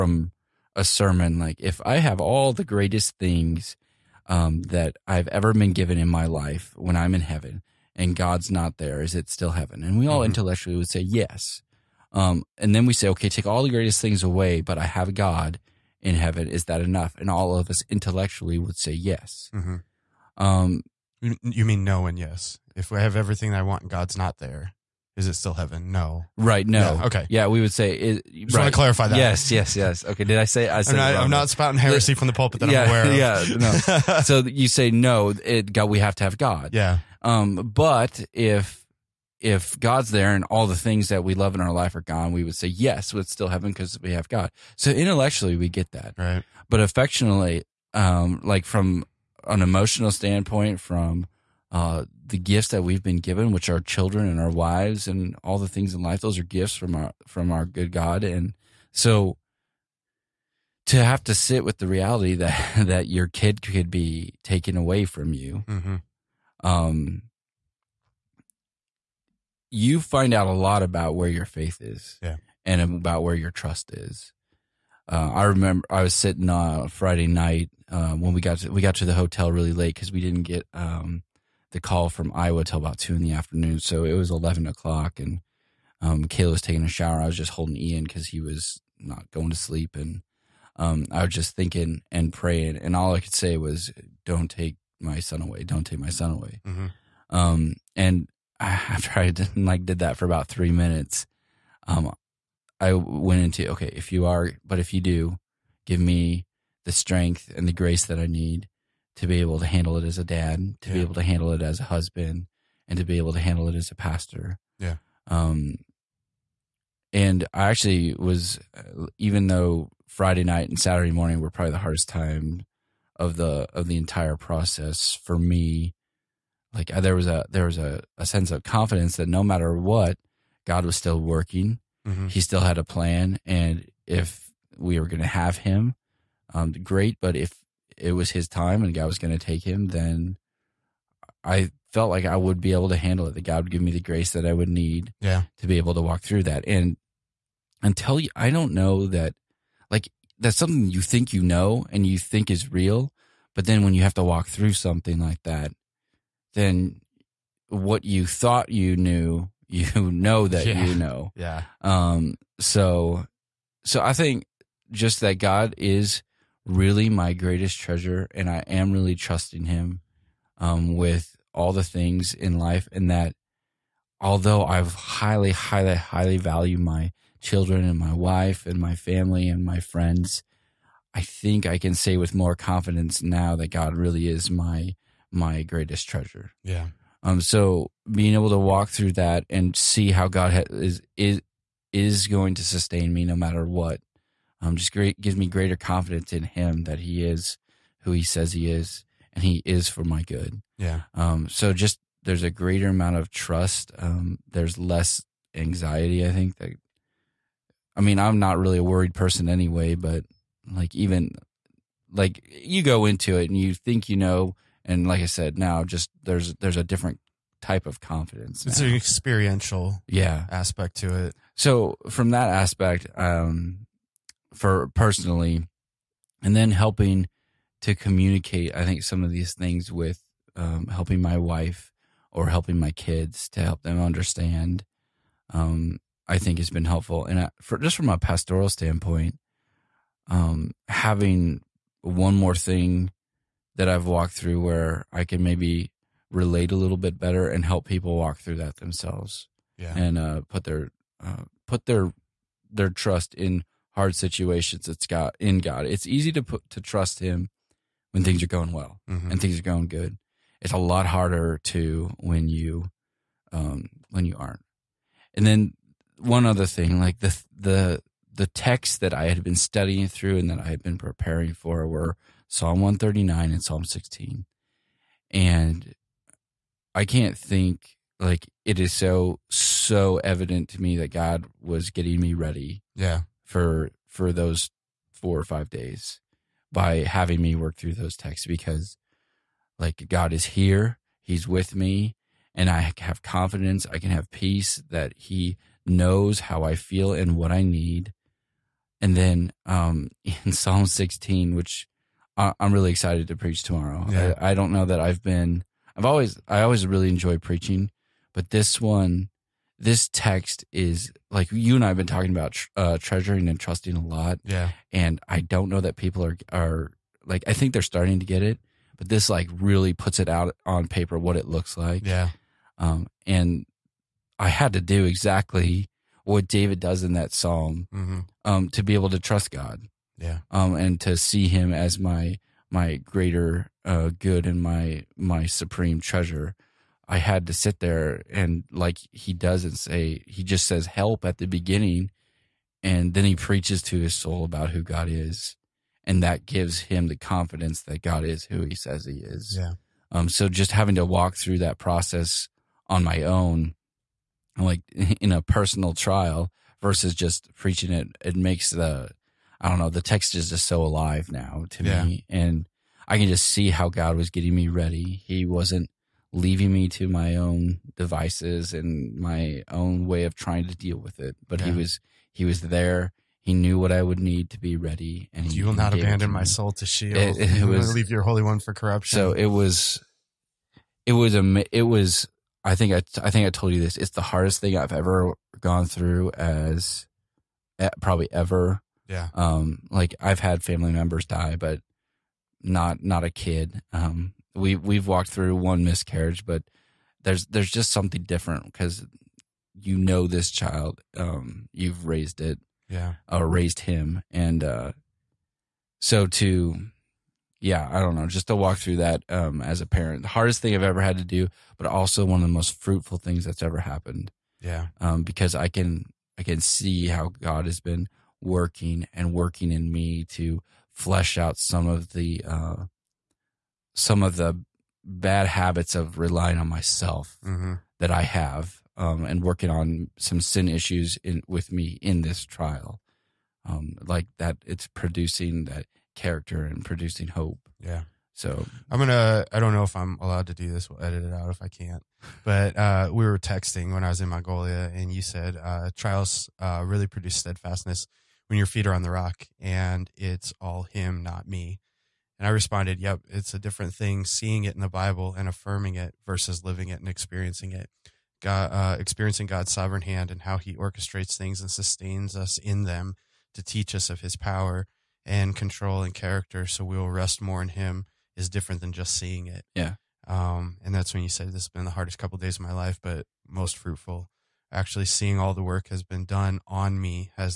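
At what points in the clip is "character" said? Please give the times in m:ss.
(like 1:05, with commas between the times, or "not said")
7:16, 7:46.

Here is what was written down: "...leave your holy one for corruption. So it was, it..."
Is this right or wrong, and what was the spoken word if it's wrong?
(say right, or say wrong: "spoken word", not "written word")
right.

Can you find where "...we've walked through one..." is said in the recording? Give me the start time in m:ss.
6:34.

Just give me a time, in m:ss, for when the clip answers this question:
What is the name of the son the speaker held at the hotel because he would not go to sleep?
1:27.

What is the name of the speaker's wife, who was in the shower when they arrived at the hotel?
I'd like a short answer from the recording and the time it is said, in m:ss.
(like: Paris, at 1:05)
Kayla, at 1:26.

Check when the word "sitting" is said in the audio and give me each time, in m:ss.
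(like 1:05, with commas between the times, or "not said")
1:16.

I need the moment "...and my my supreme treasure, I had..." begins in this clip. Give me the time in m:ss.
5:34.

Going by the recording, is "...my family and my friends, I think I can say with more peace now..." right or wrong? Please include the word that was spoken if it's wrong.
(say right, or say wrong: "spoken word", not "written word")
wrong: "confidence", not "peace".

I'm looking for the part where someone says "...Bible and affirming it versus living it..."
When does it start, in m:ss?
7:34.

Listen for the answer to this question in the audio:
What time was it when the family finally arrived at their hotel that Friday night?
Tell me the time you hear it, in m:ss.
1:24.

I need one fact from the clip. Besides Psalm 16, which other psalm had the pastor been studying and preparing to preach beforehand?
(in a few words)
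Psalm 139.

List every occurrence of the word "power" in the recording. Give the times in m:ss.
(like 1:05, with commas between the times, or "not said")
7:44.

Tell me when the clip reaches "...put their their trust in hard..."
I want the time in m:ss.
4:11.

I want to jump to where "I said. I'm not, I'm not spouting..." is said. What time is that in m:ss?
0:30.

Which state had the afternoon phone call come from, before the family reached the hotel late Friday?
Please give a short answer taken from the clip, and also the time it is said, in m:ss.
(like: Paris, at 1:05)
Iowa, at 1:22.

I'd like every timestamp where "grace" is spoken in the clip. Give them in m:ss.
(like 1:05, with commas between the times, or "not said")
1:47, 2:24.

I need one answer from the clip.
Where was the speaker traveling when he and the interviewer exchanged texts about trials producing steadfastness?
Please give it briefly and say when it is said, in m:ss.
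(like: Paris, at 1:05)
Mongolia, at 7:24.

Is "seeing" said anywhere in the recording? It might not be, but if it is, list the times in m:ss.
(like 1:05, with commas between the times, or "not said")
7:34, 7:49, 7:55.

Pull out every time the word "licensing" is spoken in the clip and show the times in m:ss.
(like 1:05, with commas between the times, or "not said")
not said.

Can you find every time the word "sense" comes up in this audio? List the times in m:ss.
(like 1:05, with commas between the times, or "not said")
2:08.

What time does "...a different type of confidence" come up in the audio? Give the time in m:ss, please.
3:36.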